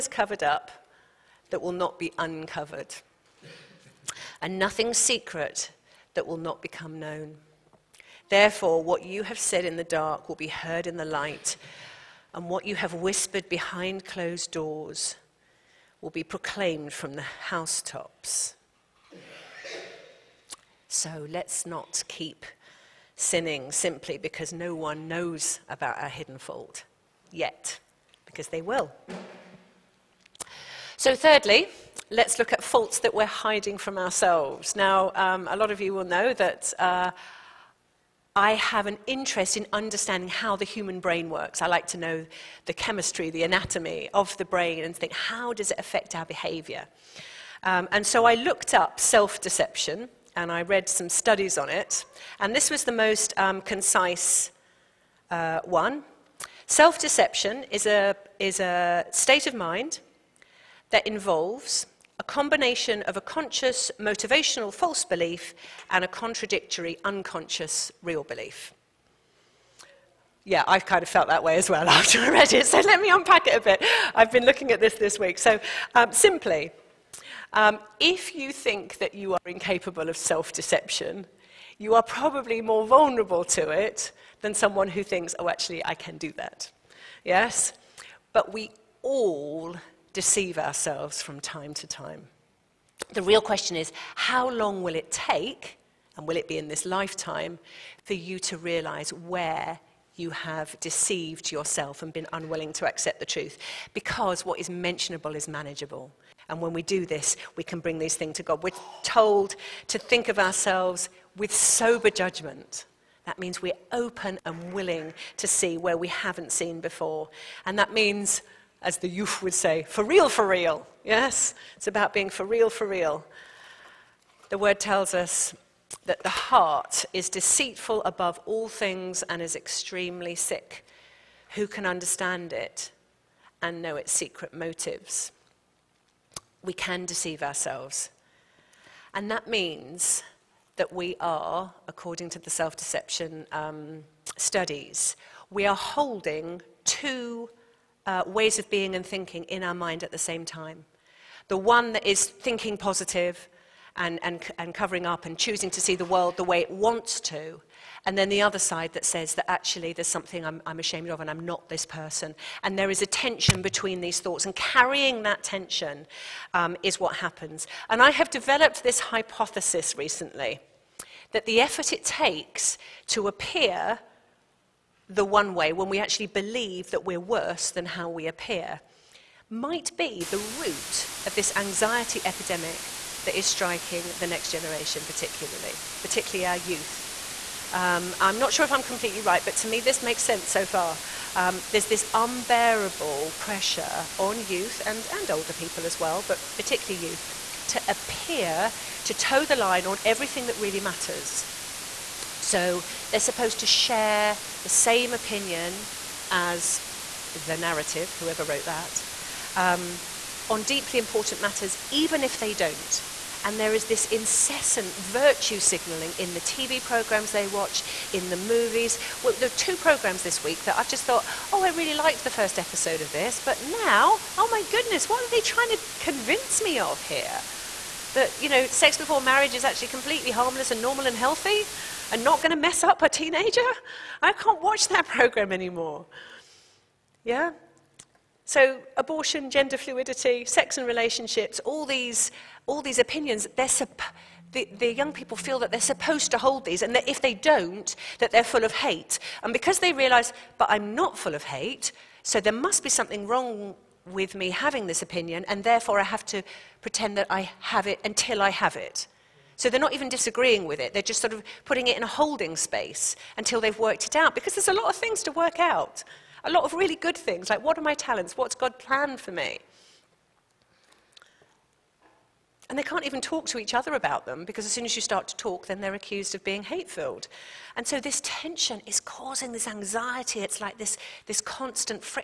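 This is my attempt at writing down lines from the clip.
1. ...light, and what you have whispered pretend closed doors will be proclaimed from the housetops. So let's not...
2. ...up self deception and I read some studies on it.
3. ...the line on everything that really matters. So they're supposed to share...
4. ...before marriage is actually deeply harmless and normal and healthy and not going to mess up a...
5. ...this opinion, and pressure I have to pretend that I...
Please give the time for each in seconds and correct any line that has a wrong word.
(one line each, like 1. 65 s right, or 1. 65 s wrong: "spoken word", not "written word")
1. 11 s wrong: "behind", not "pretend"
2. 48 s right
3. 199 s right
4. 228 s wrong: "completely", not "deeply"
5. 254 s wrong: "therefore", not "pressure".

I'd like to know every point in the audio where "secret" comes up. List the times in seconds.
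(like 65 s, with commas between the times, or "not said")
4 s, 134 s.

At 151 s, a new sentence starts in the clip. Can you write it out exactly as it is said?
The one that is thinking positive and, and, and covering up and choosing to see the world the way it wants to.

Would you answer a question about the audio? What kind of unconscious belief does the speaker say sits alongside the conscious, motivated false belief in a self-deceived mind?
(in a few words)
Contradictory unconscious real belief.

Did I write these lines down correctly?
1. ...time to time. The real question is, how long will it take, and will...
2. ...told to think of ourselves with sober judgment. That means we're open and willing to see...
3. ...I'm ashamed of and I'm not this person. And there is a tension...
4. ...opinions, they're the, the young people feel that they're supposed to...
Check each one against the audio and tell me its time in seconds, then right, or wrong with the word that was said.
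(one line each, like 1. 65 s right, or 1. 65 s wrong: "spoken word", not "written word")
1. 91 s right
2. 109 s right
3. 160 s right
4. 242 s right.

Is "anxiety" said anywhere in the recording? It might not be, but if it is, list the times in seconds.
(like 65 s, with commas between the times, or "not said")
181 s, 279 s.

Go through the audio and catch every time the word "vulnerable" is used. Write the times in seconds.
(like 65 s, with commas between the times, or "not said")
82 s.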